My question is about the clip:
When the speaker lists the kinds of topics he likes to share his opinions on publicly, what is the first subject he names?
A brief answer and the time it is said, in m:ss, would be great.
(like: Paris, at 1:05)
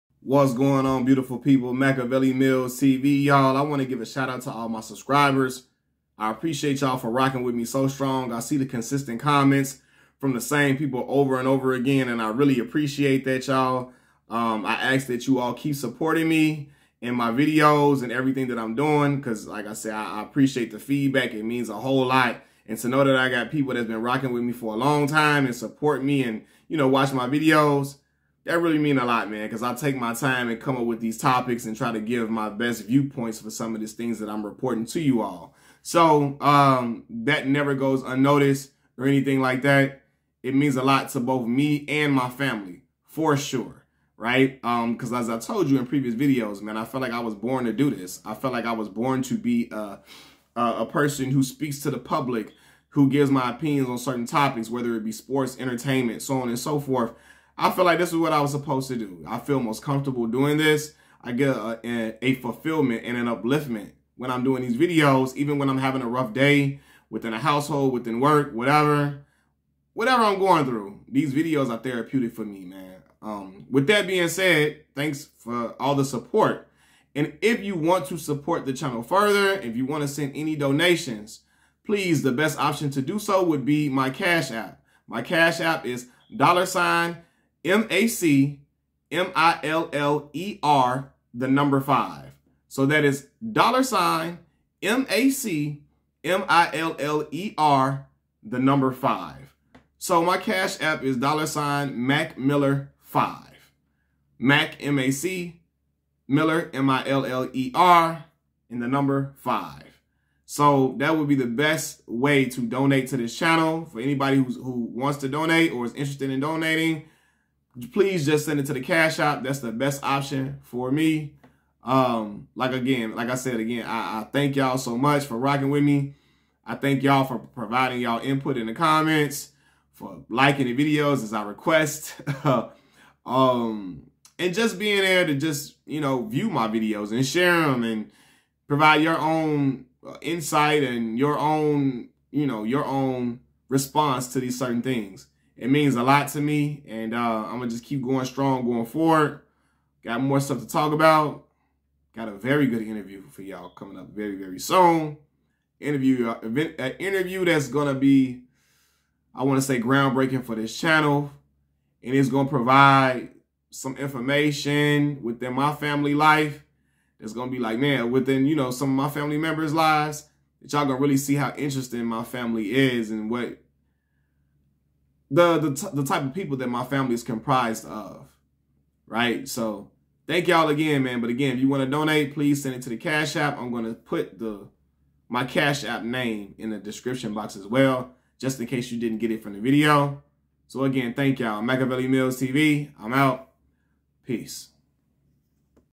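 Sports, at 0:55.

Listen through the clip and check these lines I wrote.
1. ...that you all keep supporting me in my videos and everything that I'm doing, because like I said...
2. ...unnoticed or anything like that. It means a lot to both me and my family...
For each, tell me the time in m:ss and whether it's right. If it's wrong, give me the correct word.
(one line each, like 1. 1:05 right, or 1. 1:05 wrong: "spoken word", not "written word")
1. 0:15 right
2. 0:38 right.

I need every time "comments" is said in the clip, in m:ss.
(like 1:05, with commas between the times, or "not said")
0:09, 2:08.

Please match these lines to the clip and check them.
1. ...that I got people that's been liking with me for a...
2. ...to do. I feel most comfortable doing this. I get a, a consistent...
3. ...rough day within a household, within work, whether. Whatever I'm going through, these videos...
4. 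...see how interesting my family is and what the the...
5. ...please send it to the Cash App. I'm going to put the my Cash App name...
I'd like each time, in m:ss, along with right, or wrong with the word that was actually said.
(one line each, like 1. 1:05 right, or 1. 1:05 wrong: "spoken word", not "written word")
1. 0:23 wrong: "rocking", not "liking"
2. 0:58 wrong: "fulfillment", not "consistent"
3. 1:06 wrong: "whatever", not "whether"
4. 2:51 right
5. 3:02 right.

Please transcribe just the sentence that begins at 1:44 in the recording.
Mac M-A-C Miller M-I-L-L-E-R, and the number 5.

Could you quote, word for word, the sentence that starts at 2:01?
Um, like again, like I said again, I, I thank y'all so much for rocking with me.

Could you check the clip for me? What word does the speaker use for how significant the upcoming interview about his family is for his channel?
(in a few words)
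Groundbreaking.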